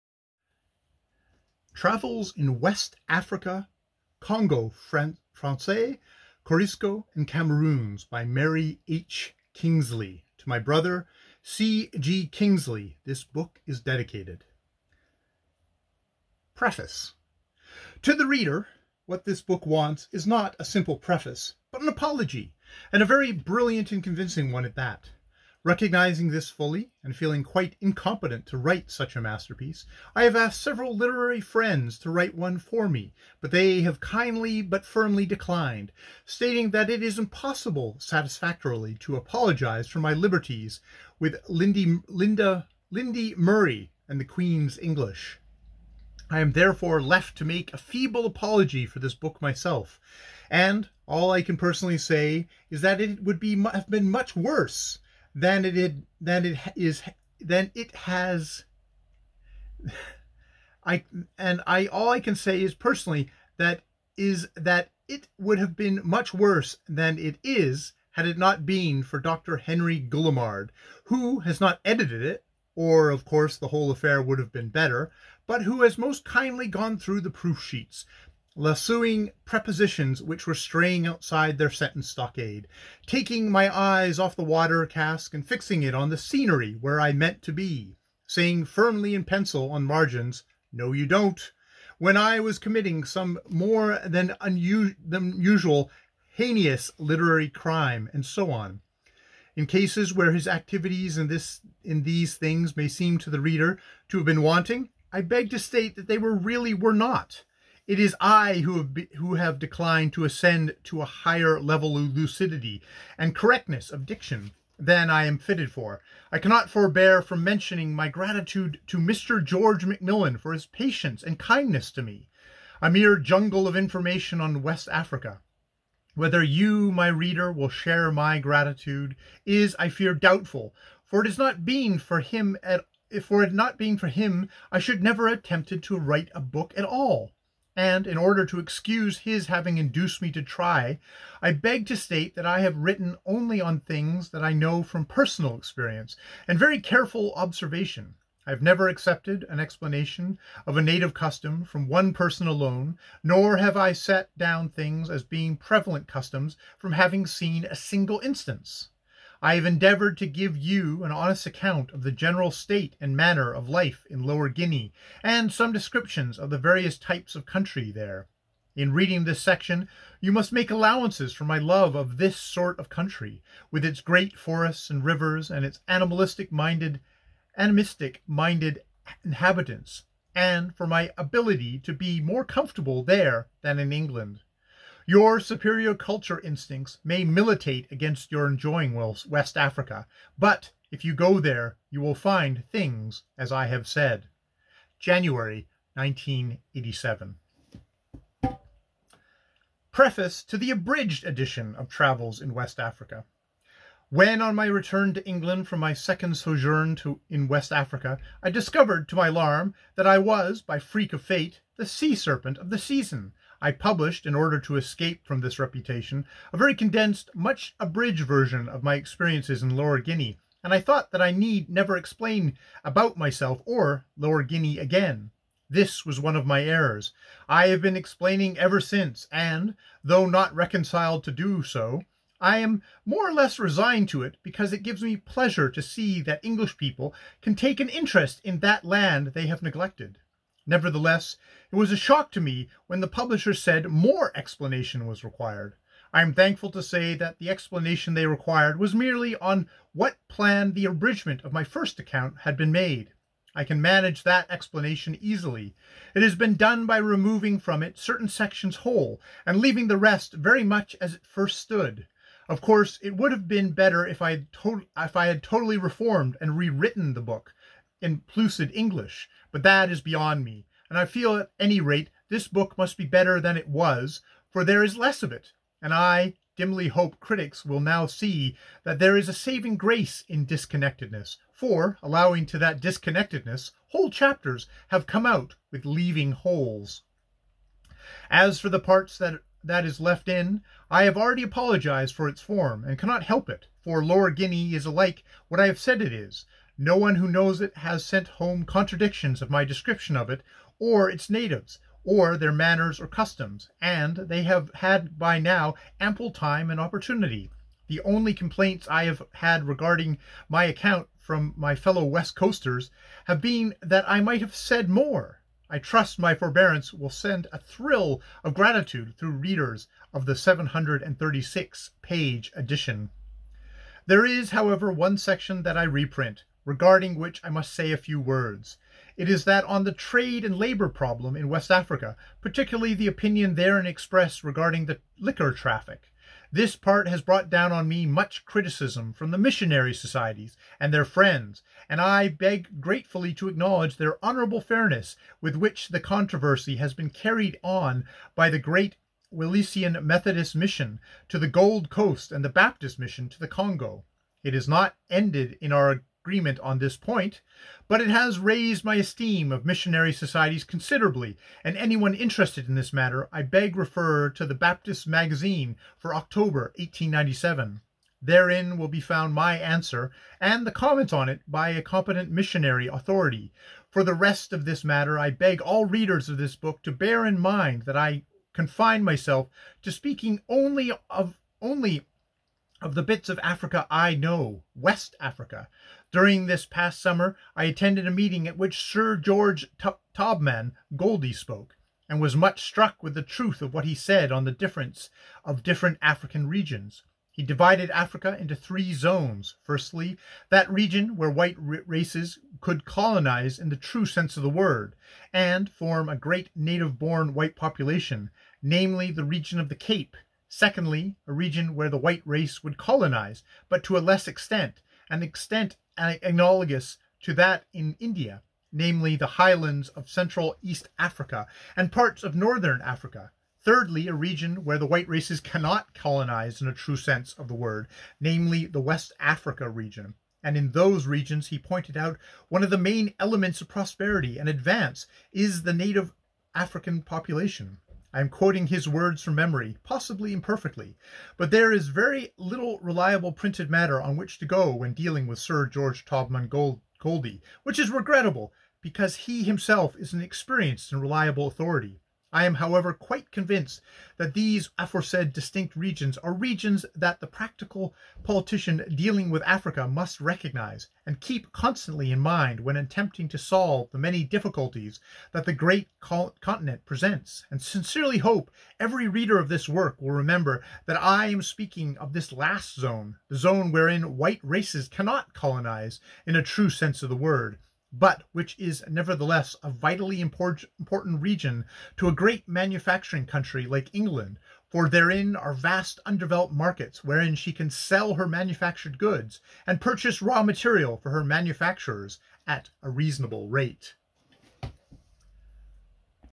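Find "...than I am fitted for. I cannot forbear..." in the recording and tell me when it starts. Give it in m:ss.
1:54.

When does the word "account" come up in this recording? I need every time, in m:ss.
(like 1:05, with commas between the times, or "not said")
2:41, 4:11, 5:10.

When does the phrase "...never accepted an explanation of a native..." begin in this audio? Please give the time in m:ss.
2:28.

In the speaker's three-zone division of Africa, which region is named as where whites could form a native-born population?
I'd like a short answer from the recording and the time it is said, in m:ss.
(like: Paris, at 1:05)
the Cape, at 6:49.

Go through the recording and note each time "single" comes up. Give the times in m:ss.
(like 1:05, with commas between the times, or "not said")
2:37.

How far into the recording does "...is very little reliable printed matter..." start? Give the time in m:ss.
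7:21.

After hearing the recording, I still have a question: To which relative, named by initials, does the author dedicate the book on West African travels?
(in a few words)
C. G. Kingsley.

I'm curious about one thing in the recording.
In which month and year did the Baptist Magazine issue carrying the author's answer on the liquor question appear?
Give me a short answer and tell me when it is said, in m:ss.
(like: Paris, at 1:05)
October 1897, at 6:06.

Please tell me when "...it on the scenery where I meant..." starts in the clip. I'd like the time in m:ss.
1:25.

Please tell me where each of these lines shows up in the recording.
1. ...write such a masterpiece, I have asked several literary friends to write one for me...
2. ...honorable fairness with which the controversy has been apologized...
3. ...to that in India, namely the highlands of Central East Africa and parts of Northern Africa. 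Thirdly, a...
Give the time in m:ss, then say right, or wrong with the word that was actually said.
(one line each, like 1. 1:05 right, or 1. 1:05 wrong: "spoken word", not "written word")
1. 0:28 right
2. 5:44 wrong: "carried", not "apologized"
3. 6:57 right.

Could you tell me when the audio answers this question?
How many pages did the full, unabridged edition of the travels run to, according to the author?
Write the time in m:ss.
5:20.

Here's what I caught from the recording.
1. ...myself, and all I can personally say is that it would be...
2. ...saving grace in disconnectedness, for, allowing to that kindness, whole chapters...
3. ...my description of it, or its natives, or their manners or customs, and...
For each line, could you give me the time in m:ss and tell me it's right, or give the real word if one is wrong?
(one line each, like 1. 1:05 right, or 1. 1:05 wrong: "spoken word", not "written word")
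1. 0:49 right
2. 4:39 wrong: "disconnectedness", not "kindness"
3. 4:59 right.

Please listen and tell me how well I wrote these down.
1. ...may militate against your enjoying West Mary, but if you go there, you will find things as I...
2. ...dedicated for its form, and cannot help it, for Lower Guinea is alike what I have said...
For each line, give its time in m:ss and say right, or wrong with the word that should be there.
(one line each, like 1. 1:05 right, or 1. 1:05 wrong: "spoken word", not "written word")
1. 3:07 wrong: "Africa", not "Mary"
2. 4:51 wrong: "apologized", not "dedicated".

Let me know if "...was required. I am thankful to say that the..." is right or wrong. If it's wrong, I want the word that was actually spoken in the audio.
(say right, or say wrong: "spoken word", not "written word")
right.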